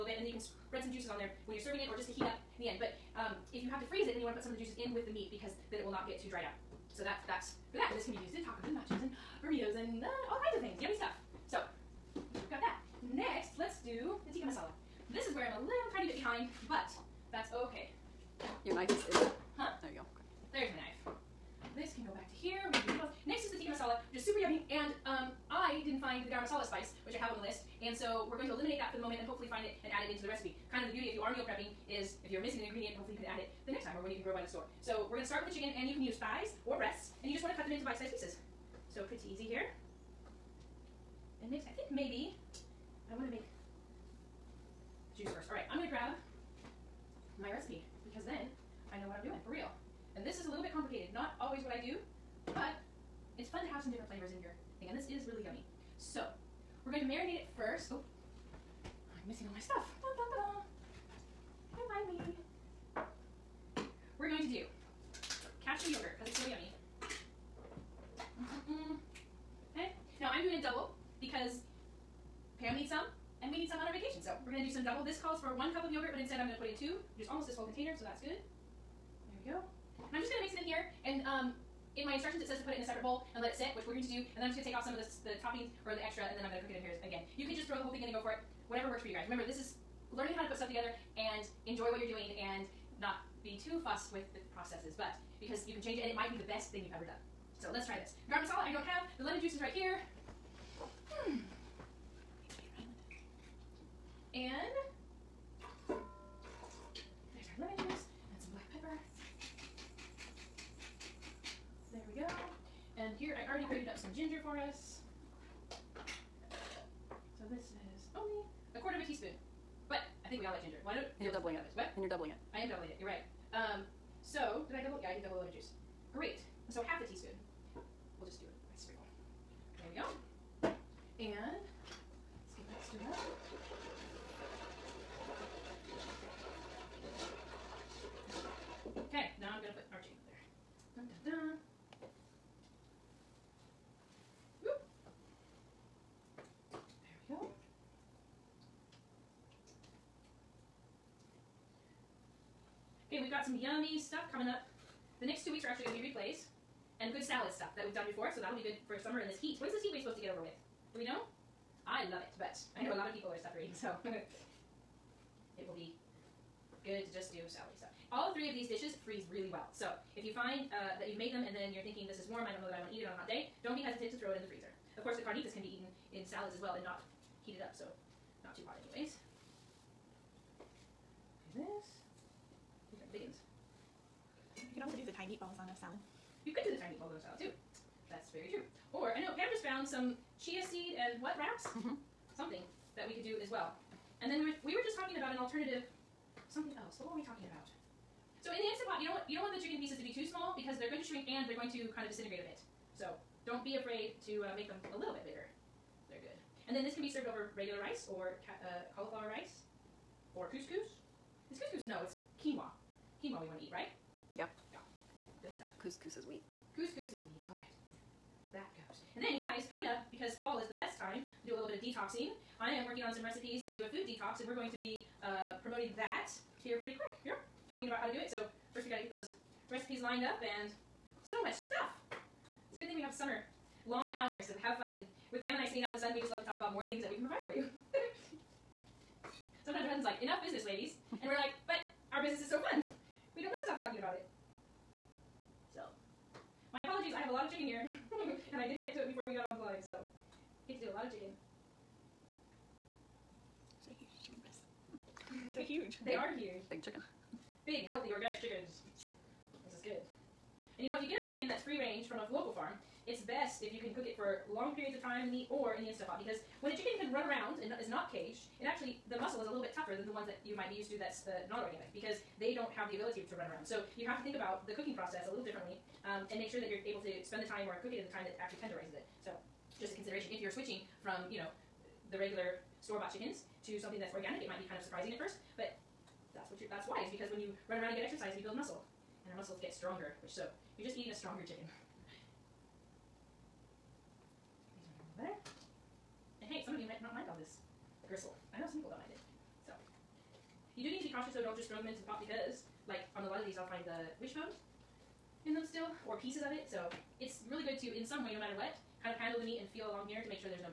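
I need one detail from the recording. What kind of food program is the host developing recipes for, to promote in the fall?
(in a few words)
food detox.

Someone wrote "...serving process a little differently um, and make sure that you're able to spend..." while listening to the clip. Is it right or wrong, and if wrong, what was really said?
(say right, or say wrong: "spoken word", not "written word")
wrong: "cooking", not "serving".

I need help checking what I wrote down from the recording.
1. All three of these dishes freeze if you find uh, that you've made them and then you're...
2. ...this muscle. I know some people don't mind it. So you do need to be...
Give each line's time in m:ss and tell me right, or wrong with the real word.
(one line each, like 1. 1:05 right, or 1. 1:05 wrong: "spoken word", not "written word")
1. 2:48 right
2. 4:57 wrong: "gristle", not "muscle".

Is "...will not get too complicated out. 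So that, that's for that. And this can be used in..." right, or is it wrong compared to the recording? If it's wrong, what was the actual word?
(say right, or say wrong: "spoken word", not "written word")
wrong: "dried", not "complicated".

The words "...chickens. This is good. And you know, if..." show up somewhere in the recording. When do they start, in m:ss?
4:18.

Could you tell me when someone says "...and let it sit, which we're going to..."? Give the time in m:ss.
1:23.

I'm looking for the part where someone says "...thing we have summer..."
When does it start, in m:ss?
3:52.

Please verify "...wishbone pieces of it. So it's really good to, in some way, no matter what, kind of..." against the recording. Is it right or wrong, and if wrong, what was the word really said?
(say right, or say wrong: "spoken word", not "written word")
right.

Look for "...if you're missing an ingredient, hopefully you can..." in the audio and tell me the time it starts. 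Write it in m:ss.
0:32.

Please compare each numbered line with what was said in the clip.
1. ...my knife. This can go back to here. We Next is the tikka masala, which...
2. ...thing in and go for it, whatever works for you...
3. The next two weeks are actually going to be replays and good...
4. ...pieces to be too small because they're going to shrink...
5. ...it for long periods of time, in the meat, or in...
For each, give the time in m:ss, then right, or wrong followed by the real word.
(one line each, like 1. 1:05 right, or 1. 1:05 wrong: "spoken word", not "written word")
1. 0:20 right
2. 1:27 right
3. 2:35 right
4. 3:19 right
5. 4:24 right.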